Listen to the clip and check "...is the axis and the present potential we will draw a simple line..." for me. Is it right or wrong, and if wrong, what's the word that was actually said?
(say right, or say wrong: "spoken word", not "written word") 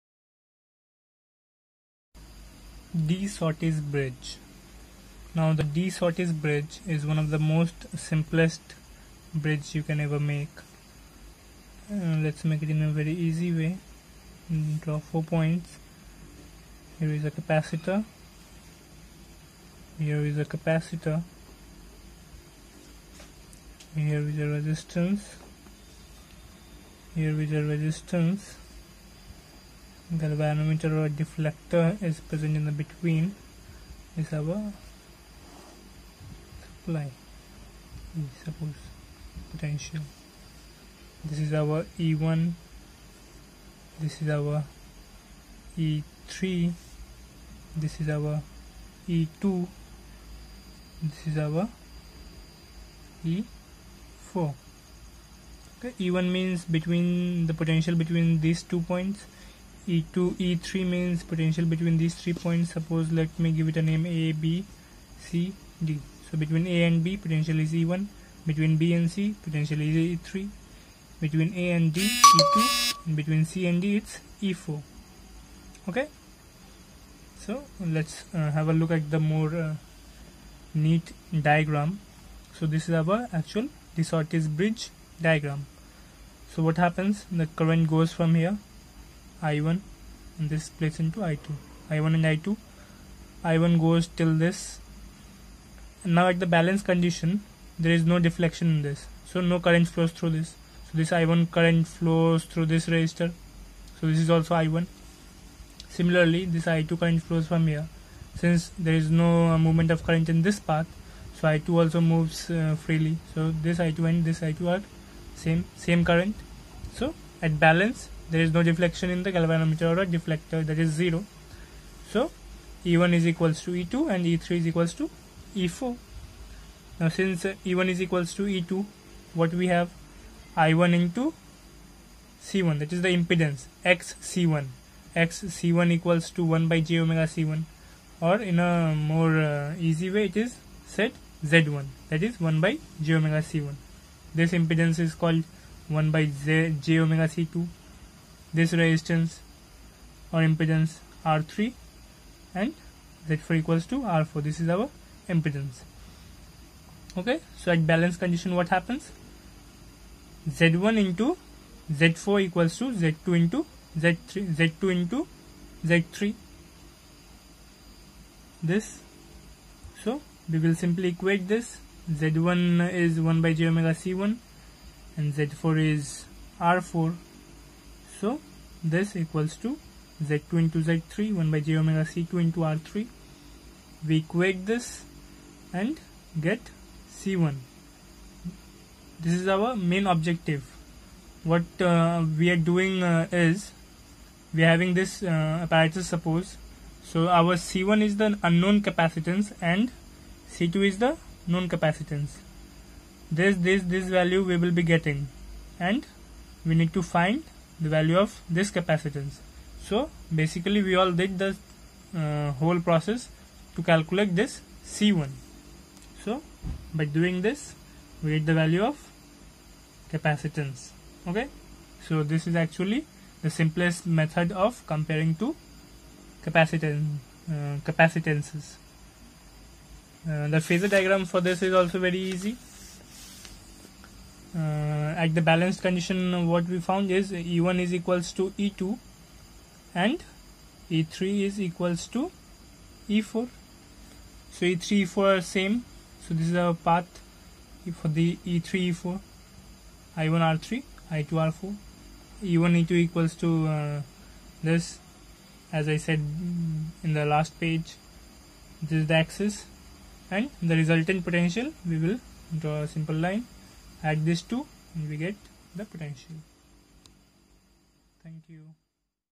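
wrong: "resultant", not "present".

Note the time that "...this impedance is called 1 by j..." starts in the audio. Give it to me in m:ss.
2:24.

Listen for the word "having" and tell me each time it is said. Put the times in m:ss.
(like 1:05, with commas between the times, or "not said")
3:14.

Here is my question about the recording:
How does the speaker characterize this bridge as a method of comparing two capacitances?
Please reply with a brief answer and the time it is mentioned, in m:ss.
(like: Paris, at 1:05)
the simplest method, at 3:43.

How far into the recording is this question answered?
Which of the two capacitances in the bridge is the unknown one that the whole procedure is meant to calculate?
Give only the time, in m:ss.
3:17.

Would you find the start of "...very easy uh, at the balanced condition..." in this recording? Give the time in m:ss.
3:51.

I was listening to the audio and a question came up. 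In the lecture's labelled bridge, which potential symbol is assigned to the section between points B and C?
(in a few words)
E3.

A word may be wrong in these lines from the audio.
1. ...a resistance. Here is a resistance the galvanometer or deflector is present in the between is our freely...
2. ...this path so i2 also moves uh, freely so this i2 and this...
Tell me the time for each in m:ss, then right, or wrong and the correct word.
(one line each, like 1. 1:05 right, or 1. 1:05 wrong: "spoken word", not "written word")
1. 0:24 wrong: "supply", not "freely"
2. 1:50 right.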